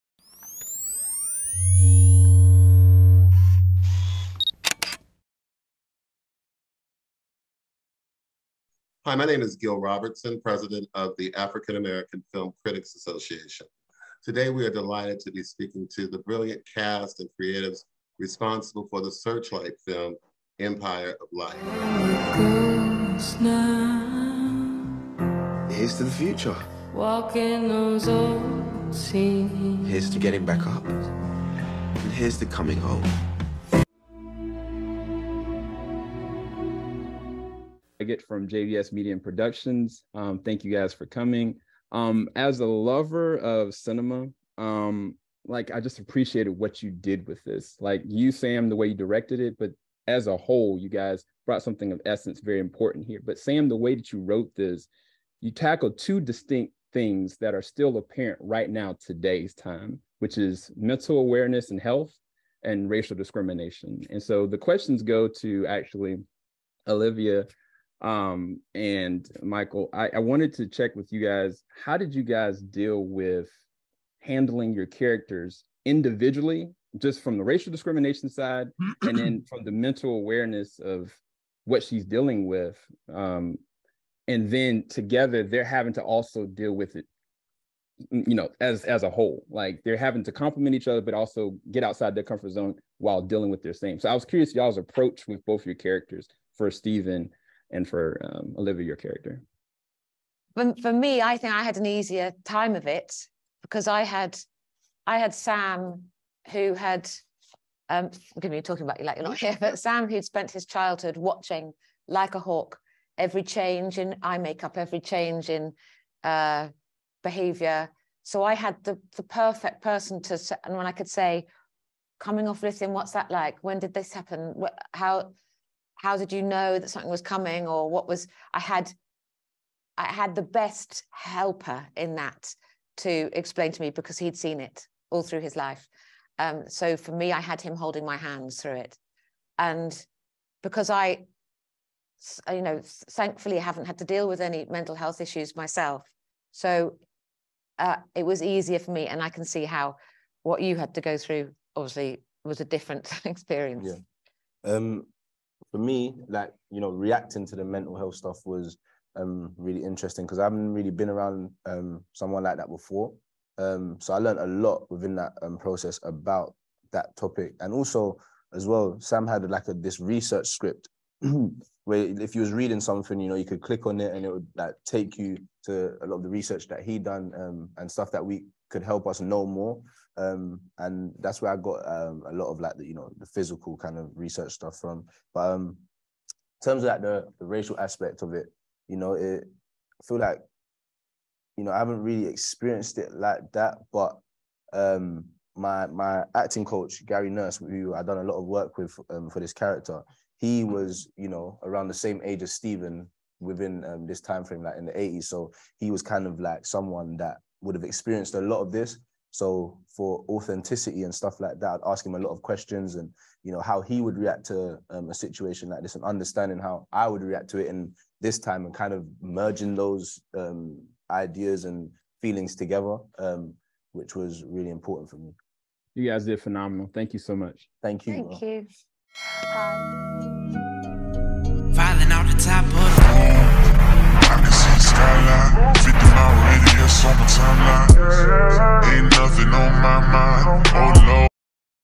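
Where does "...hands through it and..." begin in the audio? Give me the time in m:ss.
2:18.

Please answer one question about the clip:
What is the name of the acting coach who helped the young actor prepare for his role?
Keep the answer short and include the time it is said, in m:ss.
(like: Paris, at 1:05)
Gary Nurse, at 3:17.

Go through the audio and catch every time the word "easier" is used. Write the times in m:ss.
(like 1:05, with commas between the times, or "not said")
1:41, 2:28.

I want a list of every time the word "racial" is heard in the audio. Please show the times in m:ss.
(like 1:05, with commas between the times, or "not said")
1:02, 1:17, 3:07.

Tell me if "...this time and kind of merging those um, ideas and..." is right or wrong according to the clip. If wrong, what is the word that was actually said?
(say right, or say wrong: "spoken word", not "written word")
right.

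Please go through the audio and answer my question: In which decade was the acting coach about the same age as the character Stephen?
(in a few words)
the eighties.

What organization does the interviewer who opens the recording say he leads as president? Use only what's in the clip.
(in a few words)
African American Film Critics Association.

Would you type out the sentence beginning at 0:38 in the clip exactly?
Leggett from JVS Media and Productions.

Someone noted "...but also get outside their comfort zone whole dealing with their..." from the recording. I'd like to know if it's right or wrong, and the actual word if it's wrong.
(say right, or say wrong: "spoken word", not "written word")
wrong: "while", not "whole".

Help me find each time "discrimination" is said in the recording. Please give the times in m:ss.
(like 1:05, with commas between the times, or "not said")
1:03, 1:17.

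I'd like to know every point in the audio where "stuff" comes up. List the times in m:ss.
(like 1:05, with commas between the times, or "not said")
2:38, 2:57, 3:04, 3:31.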